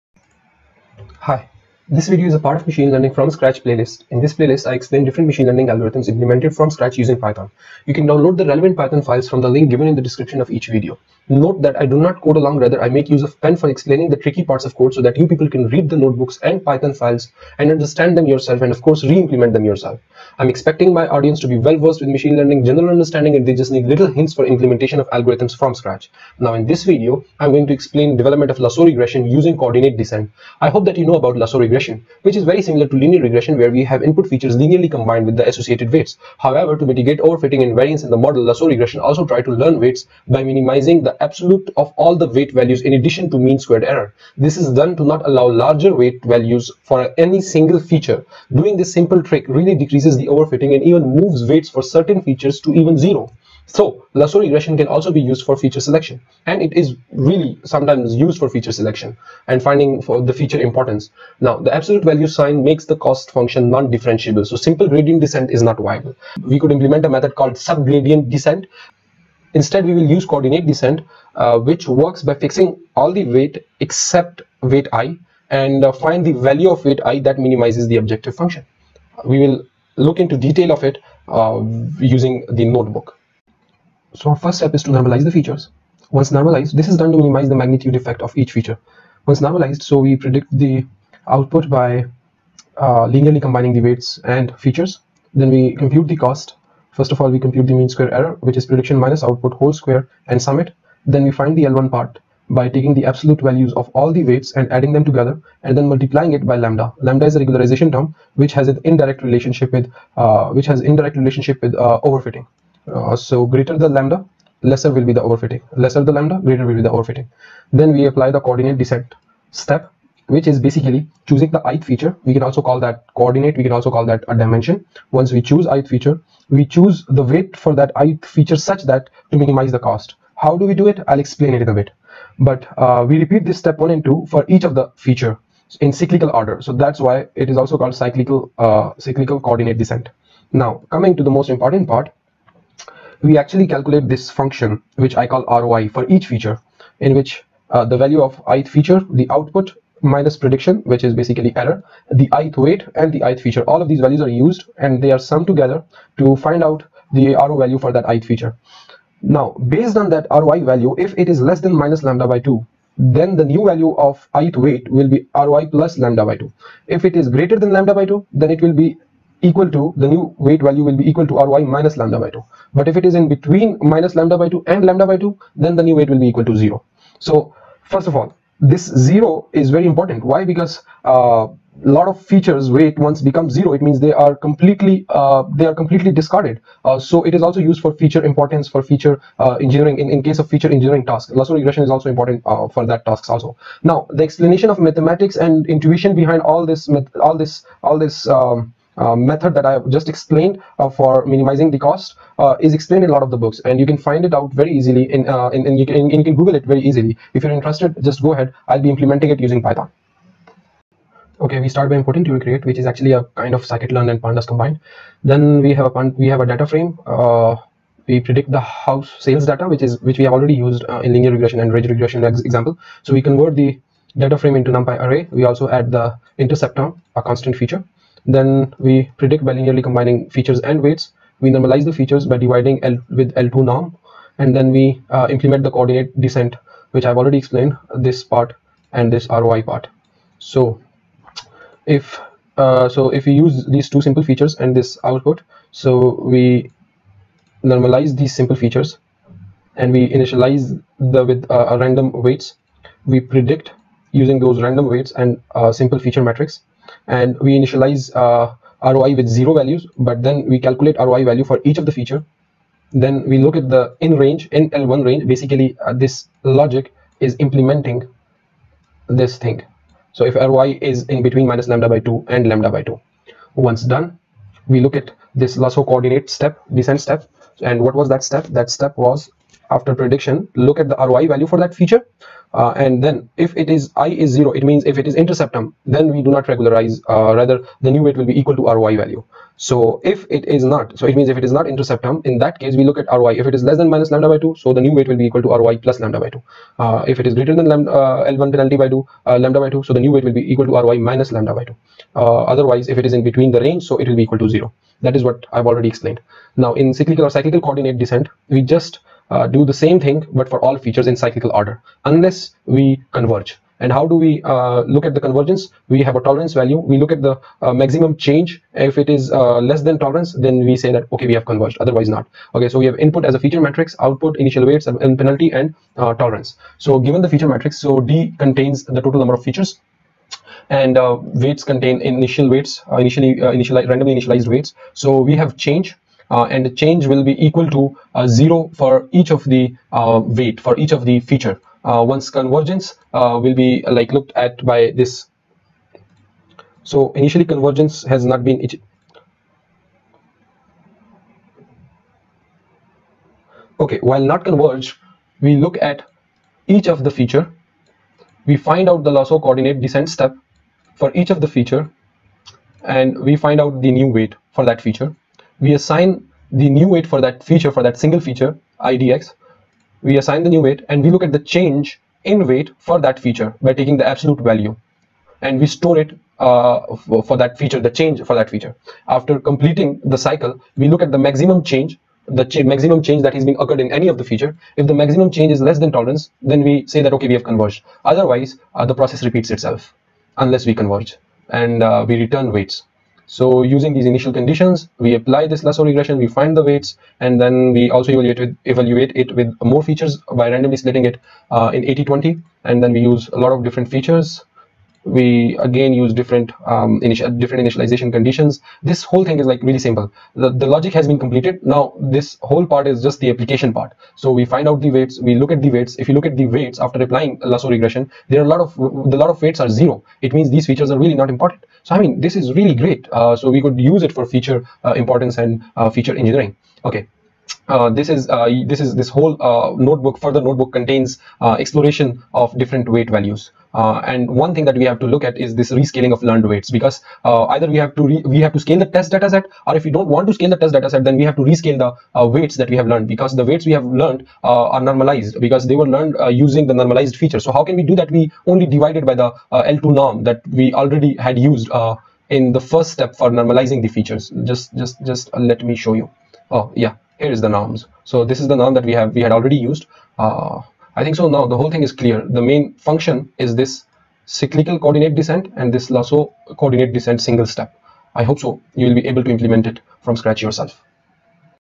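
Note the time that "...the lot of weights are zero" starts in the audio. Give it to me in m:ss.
6:58.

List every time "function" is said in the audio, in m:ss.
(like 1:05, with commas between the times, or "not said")
1:03, 1:18, 2:24, 7:42.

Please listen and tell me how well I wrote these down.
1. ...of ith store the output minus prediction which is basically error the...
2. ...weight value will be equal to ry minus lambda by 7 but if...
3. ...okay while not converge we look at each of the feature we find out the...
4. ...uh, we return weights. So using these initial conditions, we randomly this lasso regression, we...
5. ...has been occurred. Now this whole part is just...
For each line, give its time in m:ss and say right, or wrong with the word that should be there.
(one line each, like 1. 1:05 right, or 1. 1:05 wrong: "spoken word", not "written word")
1. 2:28 wrong: "feature", not "store"
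2. 2:50 wrong: "2", not "7"
3. 5:53 right
4. 6:31 wrong: "apply", not "randomly"
5. 6:50 wrong: "completed", not "occurred".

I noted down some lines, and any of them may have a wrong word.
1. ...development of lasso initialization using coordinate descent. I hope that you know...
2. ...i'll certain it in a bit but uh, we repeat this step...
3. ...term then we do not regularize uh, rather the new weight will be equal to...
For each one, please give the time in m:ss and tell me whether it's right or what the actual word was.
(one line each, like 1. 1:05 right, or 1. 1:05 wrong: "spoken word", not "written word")
1. 0:28 wrong: "regression", not "initialization"
2. 2:11 wrong: "explain", not "certain"
3. 4:45 right.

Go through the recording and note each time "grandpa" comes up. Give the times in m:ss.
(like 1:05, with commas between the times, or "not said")
not said.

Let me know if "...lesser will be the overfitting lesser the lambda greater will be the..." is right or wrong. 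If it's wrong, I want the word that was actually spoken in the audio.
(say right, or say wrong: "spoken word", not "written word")
right.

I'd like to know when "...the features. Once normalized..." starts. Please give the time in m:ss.
1:25.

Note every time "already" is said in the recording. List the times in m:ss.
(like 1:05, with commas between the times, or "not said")
3:40, 3:57, 5:05, 7:30, 7:39.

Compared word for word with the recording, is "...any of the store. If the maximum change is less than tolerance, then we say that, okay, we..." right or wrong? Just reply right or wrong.
wrong.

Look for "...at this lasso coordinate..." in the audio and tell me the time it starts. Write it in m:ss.
4:34.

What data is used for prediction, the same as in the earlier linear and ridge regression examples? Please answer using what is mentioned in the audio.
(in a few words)
house sales data.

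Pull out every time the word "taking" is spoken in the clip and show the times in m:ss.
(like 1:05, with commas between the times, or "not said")
1:42, 6:13.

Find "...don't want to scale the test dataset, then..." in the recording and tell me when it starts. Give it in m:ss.
7:19.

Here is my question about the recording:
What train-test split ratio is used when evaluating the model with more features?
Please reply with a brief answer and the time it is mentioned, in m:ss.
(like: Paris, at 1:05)
80-20, at 6:41.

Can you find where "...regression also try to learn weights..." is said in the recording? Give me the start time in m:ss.
0:38.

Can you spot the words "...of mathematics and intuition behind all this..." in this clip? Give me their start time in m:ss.
3:14.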